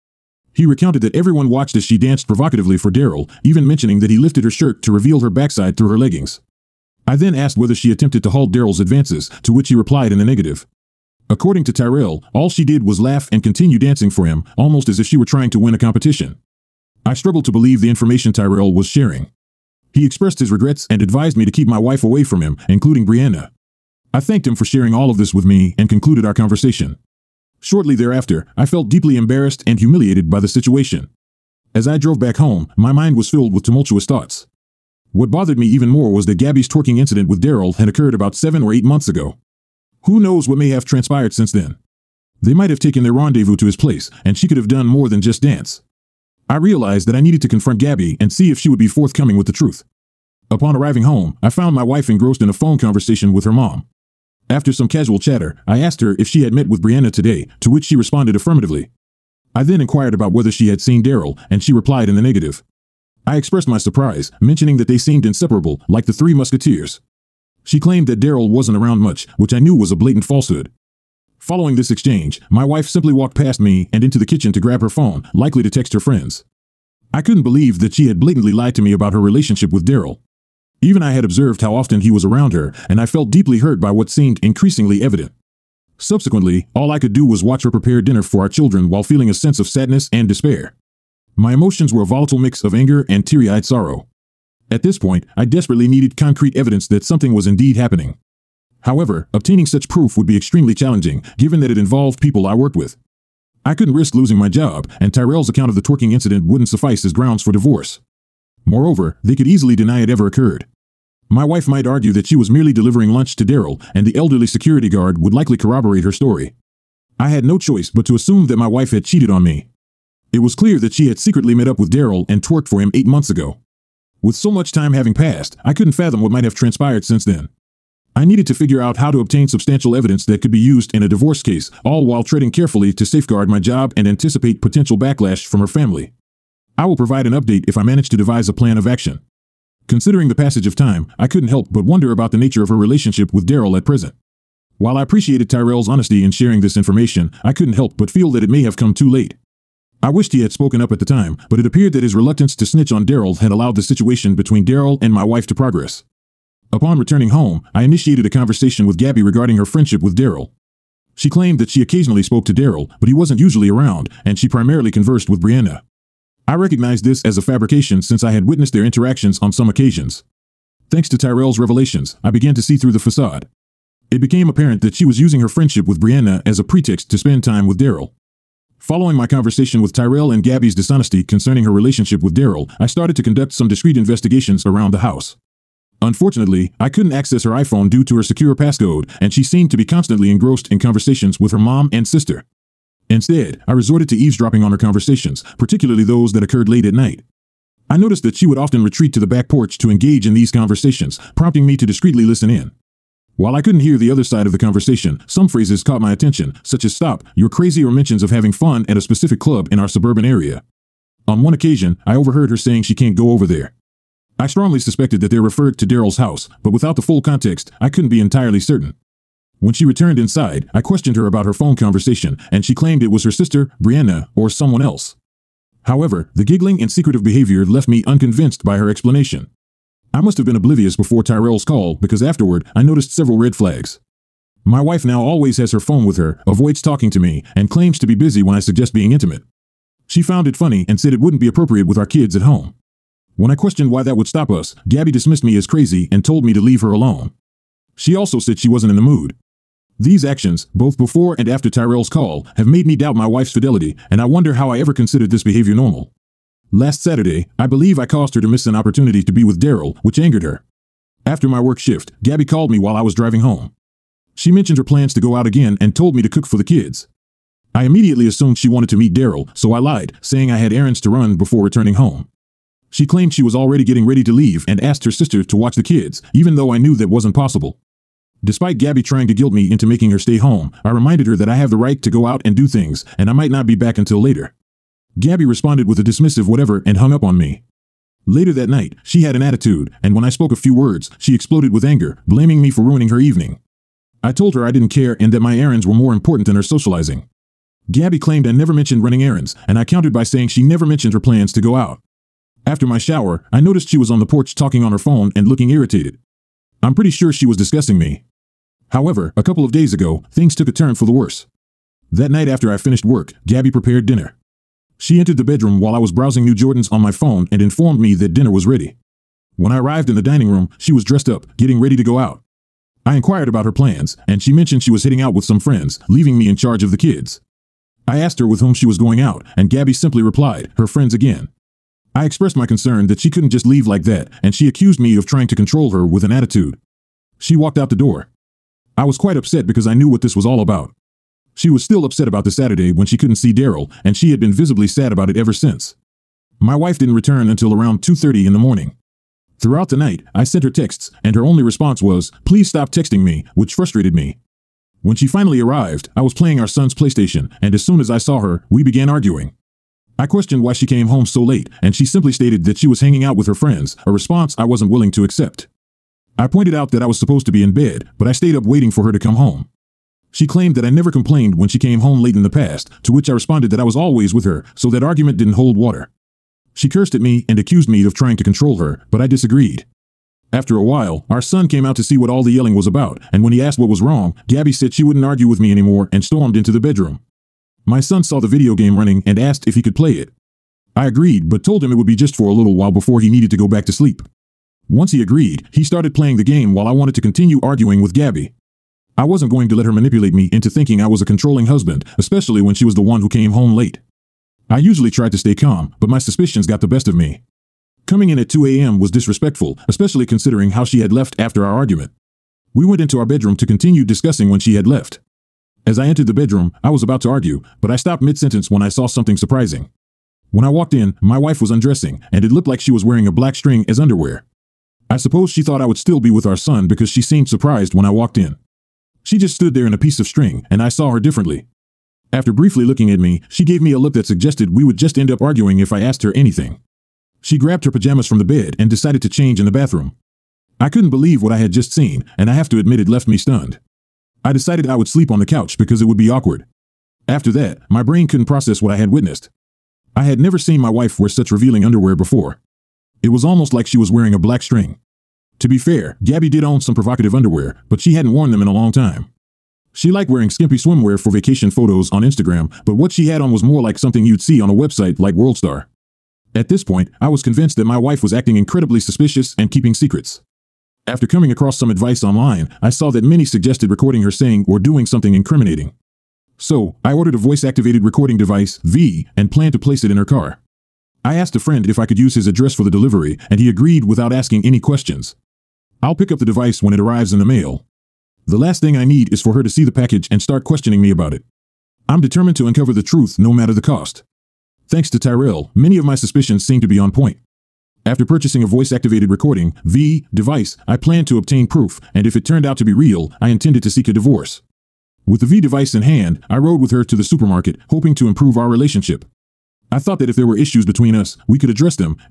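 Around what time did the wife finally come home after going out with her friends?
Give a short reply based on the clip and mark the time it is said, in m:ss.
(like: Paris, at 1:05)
2:30 a.m., at 5:48.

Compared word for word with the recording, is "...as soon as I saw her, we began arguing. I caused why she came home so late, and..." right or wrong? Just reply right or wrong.
wrong.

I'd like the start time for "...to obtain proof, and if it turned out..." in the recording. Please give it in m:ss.
8:21.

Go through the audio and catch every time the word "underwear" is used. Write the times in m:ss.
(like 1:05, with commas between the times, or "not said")
7:03, 7:31, 7:37.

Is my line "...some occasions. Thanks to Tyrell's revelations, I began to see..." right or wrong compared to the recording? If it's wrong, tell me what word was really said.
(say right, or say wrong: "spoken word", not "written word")
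right.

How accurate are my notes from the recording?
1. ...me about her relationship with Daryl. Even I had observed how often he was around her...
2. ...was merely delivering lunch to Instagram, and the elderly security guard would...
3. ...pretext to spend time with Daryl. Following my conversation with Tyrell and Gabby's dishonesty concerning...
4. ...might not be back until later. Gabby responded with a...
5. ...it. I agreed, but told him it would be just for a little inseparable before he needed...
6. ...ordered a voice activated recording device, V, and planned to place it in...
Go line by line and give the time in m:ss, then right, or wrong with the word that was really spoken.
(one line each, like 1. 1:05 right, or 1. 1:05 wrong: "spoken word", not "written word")
1. 1:18 right
2. 1:52 wrong: "Daryl", not "Instagram"
3. 2:56 right
4. 4:43 right
5. 6:30 wrong: "while", not "inseparable"
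6. 7:57 right.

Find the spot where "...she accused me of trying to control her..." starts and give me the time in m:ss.
5:34.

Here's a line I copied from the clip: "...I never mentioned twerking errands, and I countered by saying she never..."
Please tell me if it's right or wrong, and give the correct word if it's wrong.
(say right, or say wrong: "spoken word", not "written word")
wrong: "running", not "twerking".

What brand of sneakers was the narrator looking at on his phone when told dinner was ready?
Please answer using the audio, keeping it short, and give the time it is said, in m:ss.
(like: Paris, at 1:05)
Jordans, at 5:16.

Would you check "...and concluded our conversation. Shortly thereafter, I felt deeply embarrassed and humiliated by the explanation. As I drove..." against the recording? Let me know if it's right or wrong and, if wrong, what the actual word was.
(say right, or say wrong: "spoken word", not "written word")
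wrong: "situation", not "explanation".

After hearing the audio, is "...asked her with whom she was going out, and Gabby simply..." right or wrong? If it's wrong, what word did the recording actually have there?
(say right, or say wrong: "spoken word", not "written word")
right.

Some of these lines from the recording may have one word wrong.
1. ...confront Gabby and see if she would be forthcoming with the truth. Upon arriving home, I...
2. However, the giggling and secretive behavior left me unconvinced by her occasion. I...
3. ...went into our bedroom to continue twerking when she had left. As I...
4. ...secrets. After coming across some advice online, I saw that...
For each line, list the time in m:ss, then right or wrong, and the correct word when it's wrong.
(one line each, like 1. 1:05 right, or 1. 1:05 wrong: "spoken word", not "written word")
1. 0:47 right
2. 3:45 wrong: "explanation", not "occasion"
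3. 6:52 wrong: "discussing", not "twerking"
4. 7:49 right.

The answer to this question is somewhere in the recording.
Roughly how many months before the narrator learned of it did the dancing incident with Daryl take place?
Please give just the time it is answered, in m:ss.
0:38.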